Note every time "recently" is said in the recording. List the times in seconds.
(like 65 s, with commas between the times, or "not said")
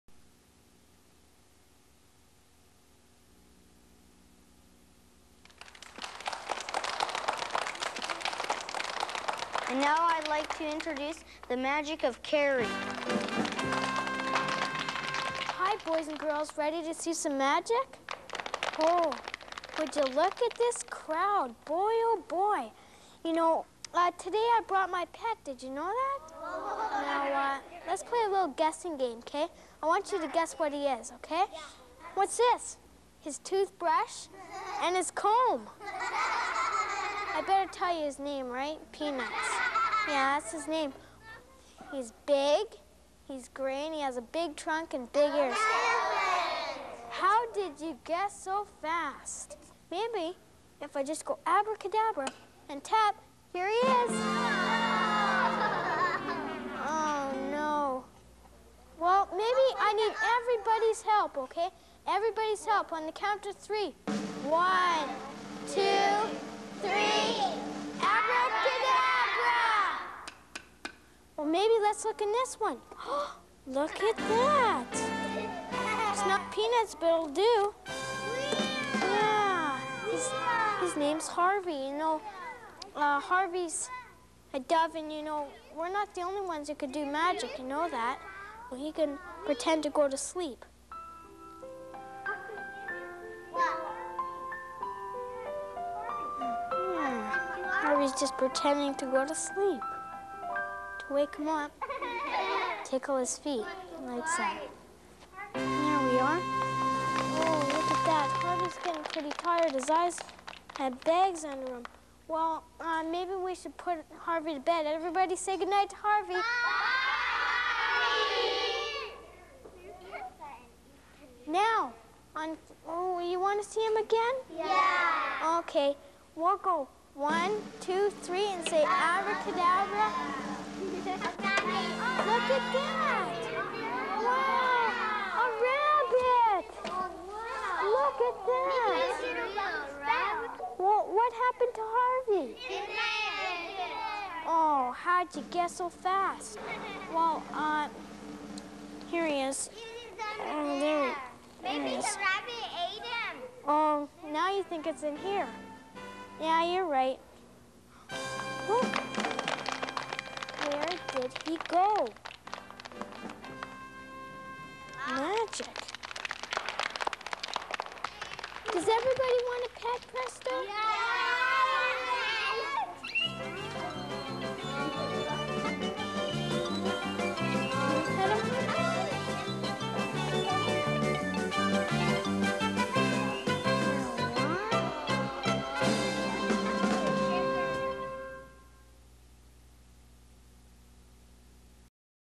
not said.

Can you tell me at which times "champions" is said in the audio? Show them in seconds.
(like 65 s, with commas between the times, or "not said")
not said.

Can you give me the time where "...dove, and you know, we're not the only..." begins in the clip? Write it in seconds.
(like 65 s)
84 s.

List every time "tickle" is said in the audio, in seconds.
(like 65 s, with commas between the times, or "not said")
102 s.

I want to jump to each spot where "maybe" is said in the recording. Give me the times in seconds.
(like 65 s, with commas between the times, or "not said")
49 s, 59 s, 113 s, 151 s.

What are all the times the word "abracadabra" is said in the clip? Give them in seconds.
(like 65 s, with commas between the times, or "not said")
51 s, 128 s.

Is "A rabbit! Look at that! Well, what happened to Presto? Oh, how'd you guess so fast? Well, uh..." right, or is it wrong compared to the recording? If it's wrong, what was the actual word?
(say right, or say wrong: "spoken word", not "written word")
wrong: "Harvey", not "Presto".